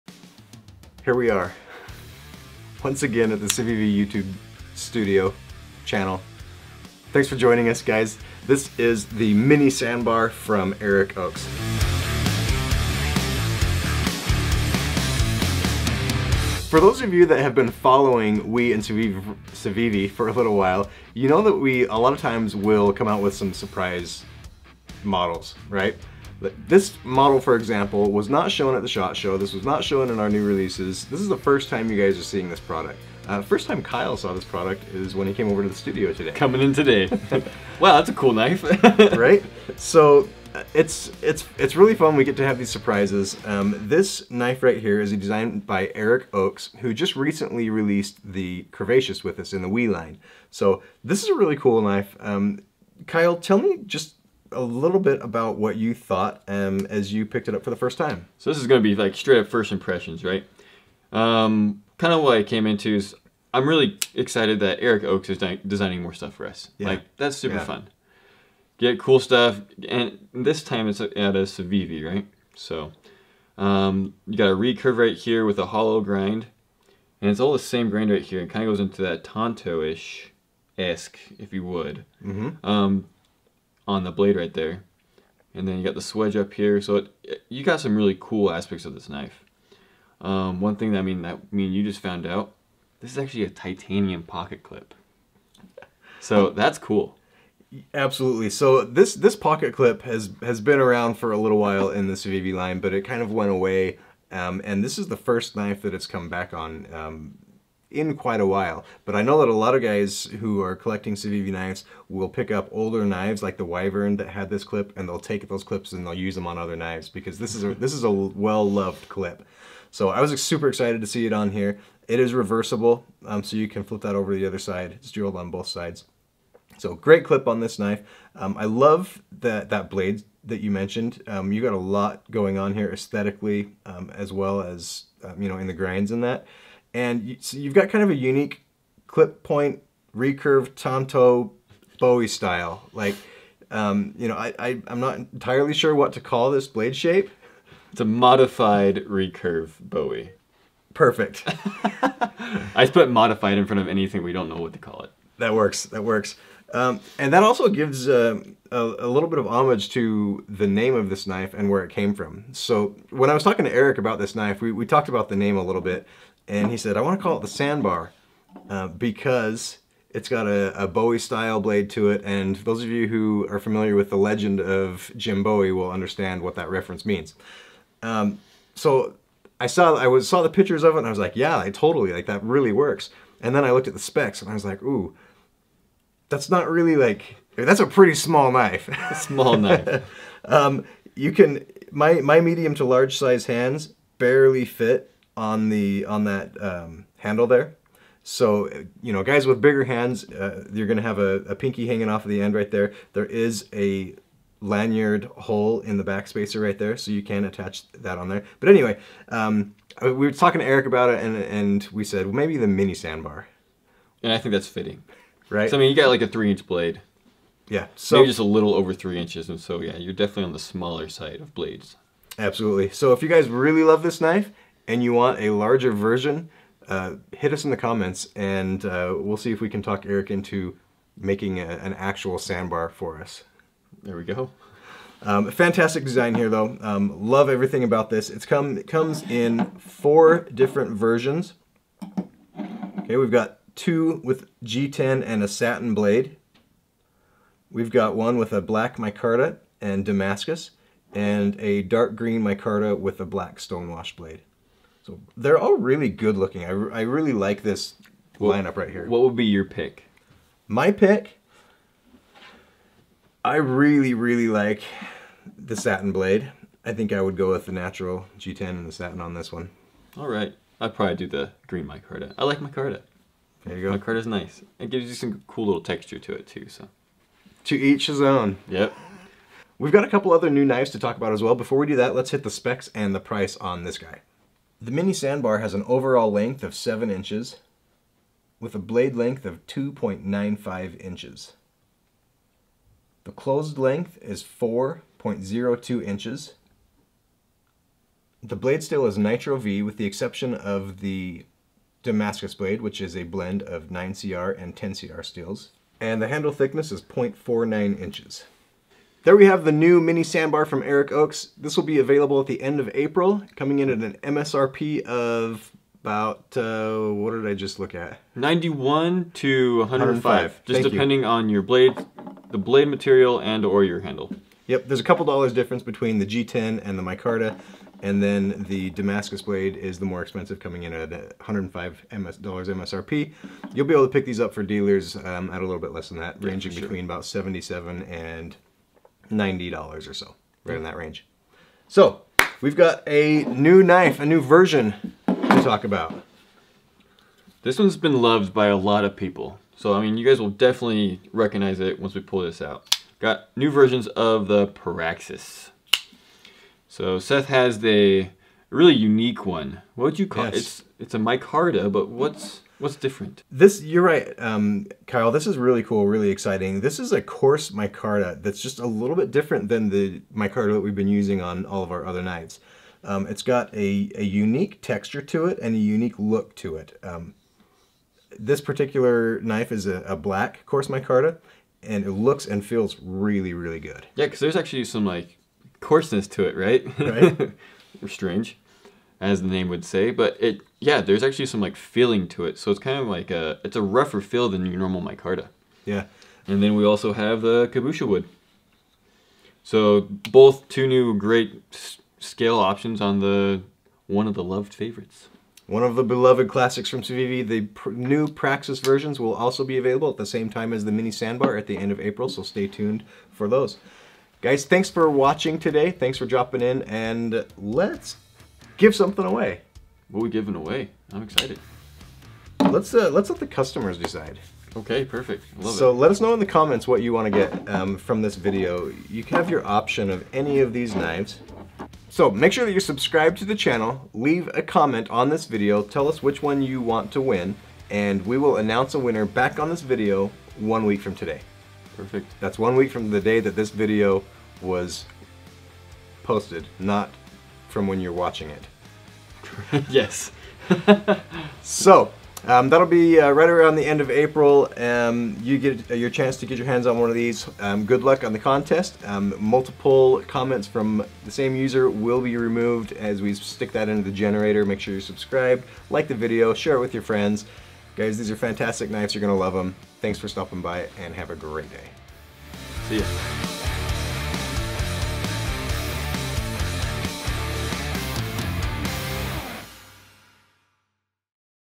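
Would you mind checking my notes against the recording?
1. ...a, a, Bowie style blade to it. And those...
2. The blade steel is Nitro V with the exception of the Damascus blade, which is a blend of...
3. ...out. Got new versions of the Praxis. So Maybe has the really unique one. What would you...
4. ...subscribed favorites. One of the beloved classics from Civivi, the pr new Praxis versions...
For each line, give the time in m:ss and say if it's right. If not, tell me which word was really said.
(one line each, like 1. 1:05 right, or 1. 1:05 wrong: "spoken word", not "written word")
1. 2:50 right
2. 4:58 right
3. 5:52 wrong: "Seth", not "Maybe"
4. 6:44 wrong: "loved", not "subscribed".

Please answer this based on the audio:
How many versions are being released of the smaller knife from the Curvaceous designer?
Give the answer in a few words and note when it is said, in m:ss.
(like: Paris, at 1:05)
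4, at 3:59.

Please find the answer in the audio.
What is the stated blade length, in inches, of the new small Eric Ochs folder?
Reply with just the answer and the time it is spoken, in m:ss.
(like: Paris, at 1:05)
2.95 inches, at 4:49.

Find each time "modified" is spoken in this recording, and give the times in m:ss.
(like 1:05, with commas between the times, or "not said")
2:28, 2:33.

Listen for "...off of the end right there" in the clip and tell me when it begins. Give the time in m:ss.
3:22.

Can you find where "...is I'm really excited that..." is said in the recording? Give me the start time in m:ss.
1:02.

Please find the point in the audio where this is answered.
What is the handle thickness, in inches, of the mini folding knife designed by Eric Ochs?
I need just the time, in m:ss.
5:07.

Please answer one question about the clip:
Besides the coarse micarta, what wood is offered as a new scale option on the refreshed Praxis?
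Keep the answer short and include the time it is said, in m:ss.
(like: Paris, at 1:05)
Cuibourtia wood, at 6:37.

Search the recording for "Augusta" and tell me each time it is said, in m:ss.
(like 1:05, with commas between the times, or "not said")
not said.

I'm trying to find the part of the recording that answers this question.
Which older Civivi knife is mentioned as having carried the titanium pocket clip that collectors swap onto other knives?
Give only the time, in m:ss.
1:53.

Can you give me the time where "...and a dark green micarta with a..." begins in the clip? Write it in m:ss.
4:11.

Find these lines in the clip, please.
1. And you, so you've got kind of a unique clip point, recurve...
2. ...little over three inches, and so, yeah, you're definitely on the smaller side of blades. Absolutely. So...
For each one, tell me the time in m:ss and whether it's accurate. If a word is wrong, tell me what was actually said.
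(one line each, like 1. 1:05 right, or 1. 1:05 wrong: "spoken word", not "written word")
1. 2:16 right
2. 3:38 right.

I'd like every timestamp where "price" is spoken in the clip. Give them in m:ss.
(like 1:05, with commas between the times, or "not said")
4:43.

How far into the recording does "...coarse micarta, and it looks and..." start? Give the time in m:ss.
6:20.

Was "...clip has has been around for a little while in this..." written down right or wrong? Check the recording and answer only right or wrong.
right.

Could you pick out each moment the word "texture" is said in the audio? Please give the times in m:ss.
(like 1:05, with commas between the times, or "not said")
4:35, 6:14.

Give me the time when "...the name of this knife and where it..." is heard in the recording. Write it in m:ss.
2:40.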